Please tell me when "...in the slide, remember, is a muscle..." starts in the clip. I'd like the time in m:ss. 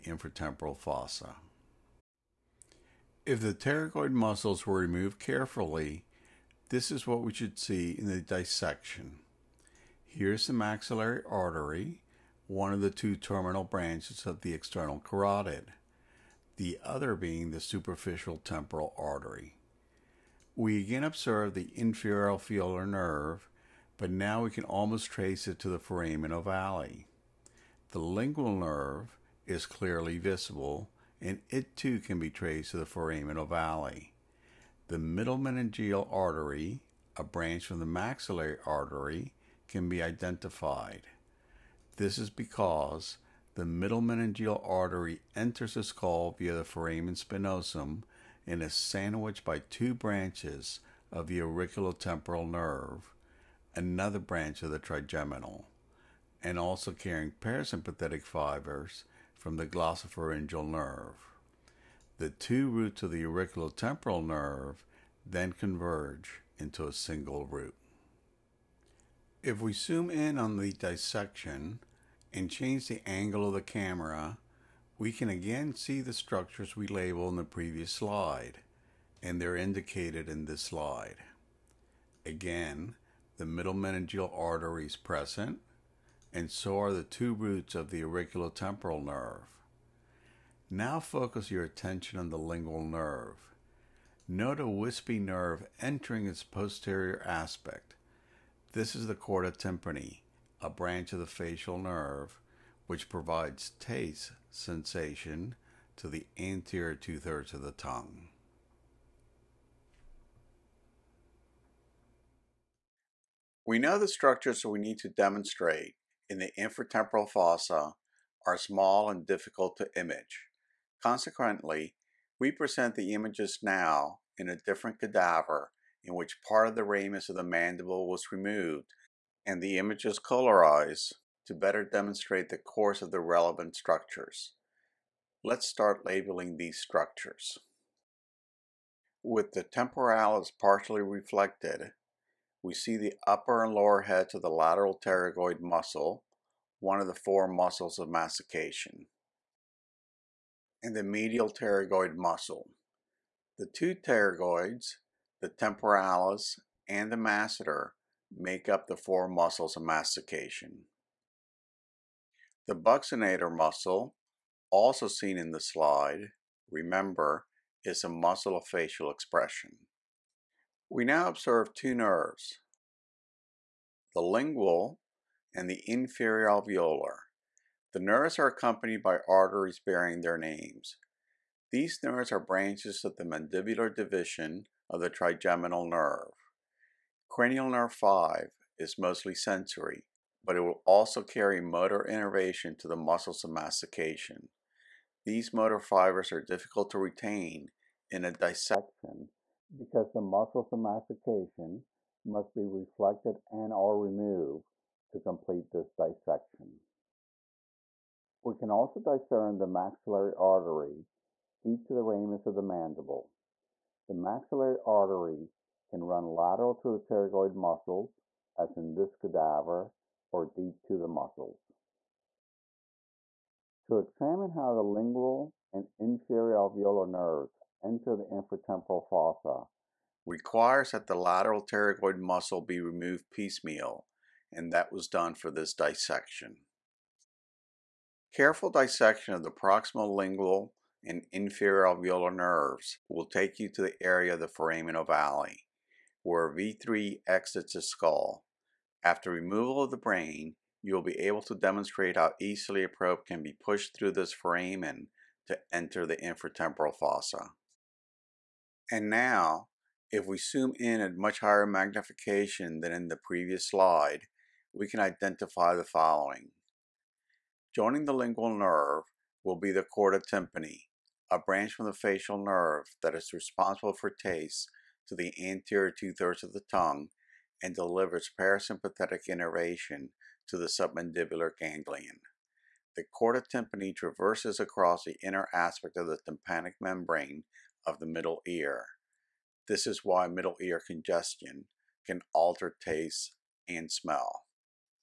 2:45.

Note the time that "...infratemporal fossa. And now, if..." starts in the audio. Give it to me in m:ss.
4:16.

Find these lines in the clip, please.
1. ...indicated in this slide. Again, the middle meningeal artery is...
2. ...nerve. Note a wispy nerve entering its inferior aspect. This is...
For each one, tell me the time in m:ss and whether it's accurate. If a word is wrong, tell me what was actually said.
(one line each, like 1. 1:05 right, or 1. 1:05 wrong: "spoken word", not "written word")
1. 1:19 right
2. 1:32 wrong: "posterior", not "inferior".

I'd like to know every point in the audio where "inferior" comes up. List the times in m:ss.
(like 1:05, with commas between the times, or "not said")
0:21, 2:55, 3:45, 4:01.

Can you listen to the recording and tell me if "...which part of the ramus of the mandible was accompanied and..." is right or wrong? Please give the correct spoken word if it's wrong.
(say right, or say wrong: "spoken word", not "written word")
wrong: "removed", not "accompanied".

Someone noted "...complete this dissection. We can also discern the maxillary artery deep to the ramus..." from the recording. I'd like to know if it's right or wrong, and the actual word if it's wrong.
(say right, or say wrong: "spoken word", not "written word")
right.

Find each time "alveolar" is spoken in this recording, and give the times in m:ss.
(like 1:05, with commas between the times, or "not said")
0:22, 2:56, 3:46, 4:01.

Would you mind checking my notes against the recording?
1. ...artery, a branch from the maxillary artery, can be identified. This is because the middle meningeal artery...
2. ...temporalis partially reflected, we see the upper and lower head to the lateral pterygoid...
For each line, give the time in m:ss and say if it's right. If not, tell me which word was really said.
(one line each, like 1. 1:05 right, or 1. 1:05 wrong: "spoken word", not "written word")
1. 0:36 right
2. 2:19 right.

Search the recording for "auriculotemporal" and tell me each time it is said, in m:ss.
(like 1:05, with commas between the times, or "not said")
0:51, 1:03, 1:28.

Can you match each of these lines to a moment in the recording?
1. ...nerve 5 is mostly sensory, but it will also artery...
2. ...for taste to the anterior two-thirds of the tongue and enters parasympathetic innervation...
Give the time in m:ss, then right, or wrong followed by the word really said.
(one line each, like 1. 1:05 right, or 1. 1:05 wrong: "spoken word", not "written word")
1. 3:07 wrong: "carry", not "artery"
2. 4:33 wrong: "delivers", not "enters".